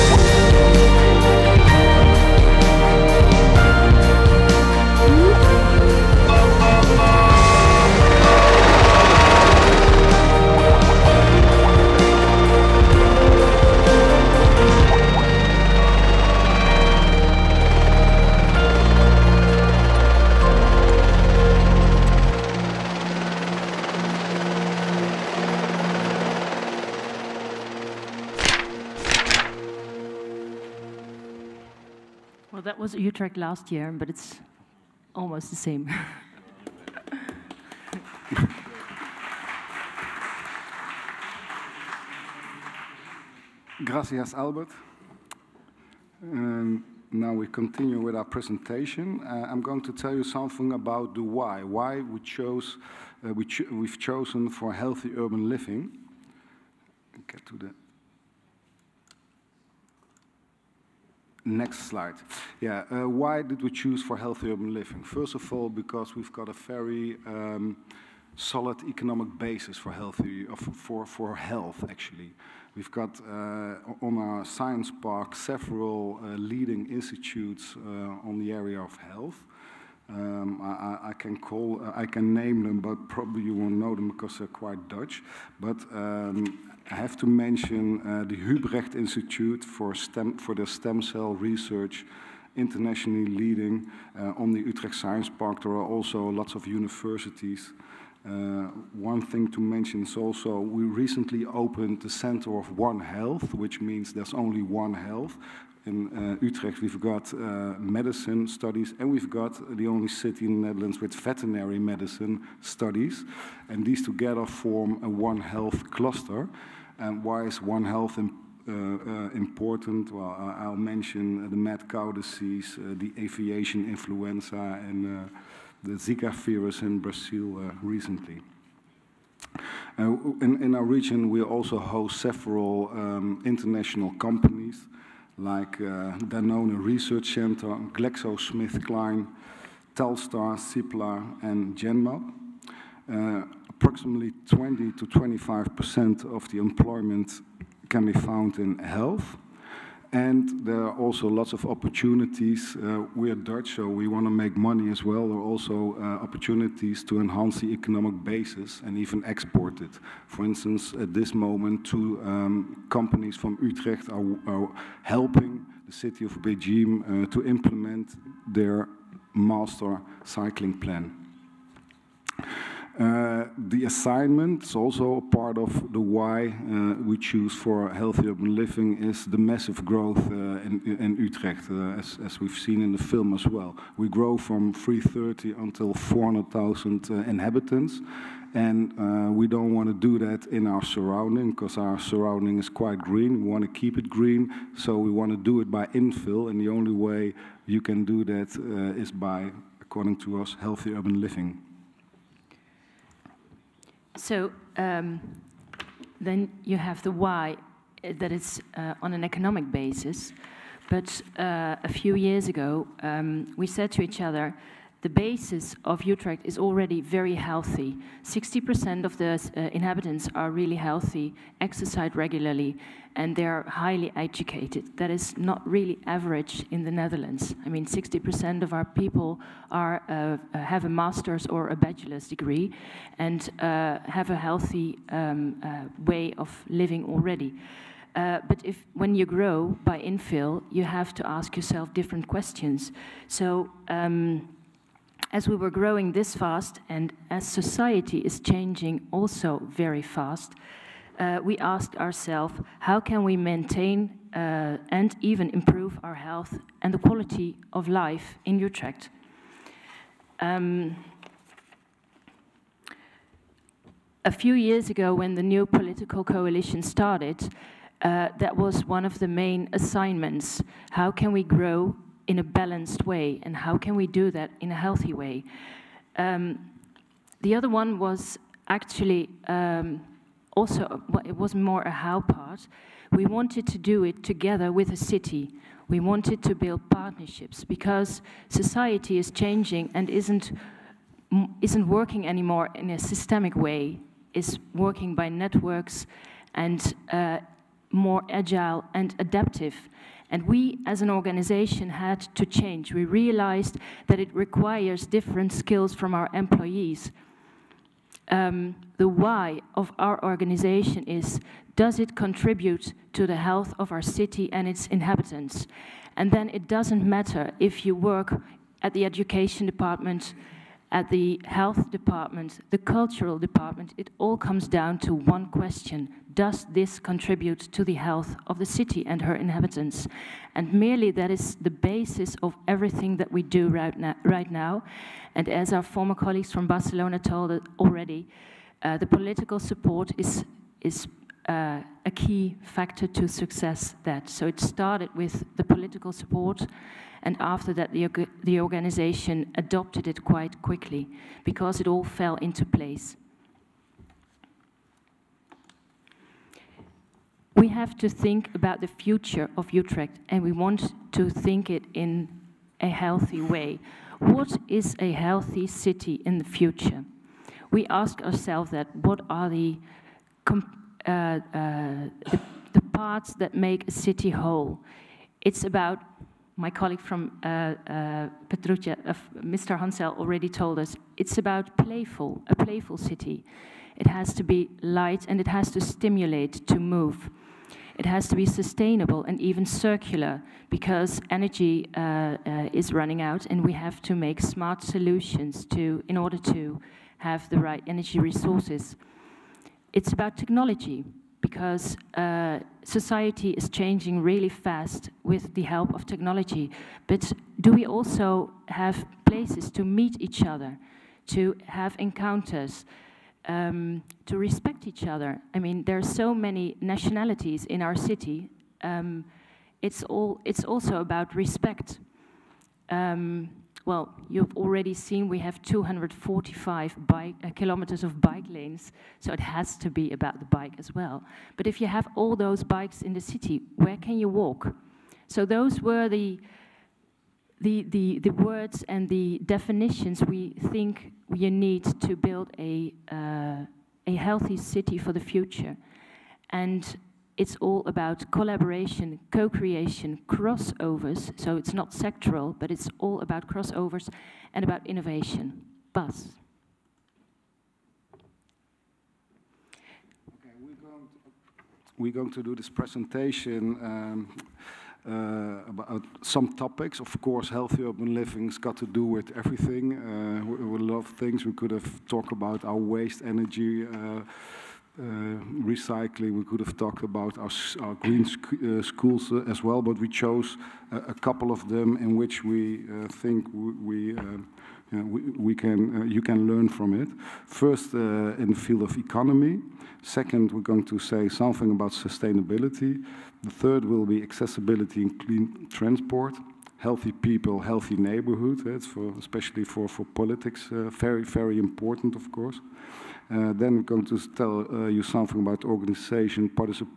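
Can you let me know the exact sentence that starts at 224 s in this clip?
That is not really average in the Netherlands.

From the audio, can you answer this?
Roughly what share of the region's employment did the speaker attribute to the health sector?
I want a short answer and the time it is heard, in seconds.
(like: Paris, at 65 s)
20 to 25 percent, at 144 s.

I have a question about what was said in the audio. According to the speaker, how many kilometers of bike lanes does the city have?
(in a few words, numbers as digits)
245.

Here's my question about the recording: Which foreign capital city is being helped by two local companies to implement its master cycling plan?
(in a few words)
Beijing.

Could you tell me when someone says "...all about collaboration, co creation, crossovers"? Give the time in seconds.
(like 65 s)
447 s.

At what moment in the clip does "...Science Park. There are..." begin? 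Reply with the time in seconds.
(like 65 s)
94 s.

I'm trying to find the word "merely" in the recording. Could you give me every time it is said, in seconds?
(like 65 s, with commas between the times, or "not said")
330 s.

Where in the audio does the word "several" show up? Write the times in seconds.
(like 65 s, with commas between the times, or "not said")
75 s, 132 s.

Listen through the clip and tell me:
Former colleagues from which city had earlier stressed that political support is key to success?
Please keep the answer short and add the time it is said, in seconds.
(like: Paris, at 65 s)
Barcelona, at 336 s.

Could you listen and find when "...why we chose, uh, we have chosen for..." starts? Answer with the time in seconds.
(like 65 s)
51 s.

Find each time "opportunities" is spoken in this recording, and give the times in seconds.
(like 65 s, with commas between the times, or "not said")
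151 s, 156 s.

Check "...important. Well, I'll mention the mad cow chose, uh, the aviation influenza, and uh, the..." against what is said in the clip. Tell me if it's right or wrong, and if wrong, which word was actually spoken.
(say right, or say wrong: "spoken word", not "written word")
wrong: "disease", not "chose".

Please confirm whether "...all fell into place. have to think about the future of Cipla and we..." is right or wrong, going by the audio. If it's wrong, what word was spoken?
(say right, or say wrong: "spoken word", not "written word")
wrong: "Utrecht", not "Cipla".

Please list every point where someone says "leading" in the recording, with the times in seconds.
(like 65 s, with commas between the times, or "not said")
76 s, 93 s.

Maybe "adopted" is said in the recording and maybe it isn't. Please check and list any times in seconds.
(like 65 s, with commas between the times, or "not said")
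349 s.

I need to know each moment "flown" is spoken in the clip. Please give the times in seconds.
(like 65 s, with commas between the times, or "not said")
not said.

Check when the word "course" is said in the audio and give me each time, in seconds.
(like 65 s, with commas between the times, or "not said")
467 s, 502 s.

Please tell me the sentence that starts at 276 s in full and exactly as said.
Um, the other one was actually um, also, well, it was more a how part.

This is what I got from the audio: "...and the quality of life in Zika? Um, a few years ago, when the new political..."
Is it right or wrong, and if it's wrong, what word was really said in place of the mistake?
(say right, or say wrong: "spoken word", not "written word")
wrong: "Utrecht", not "Zika".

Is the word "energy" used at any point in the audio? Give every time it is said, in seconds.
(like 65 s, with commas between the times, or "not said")
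391 s, 397 s, 473 s.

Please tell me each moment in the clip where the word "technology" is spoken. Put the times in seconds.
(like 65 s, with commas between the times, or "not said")
400 s, 406 s.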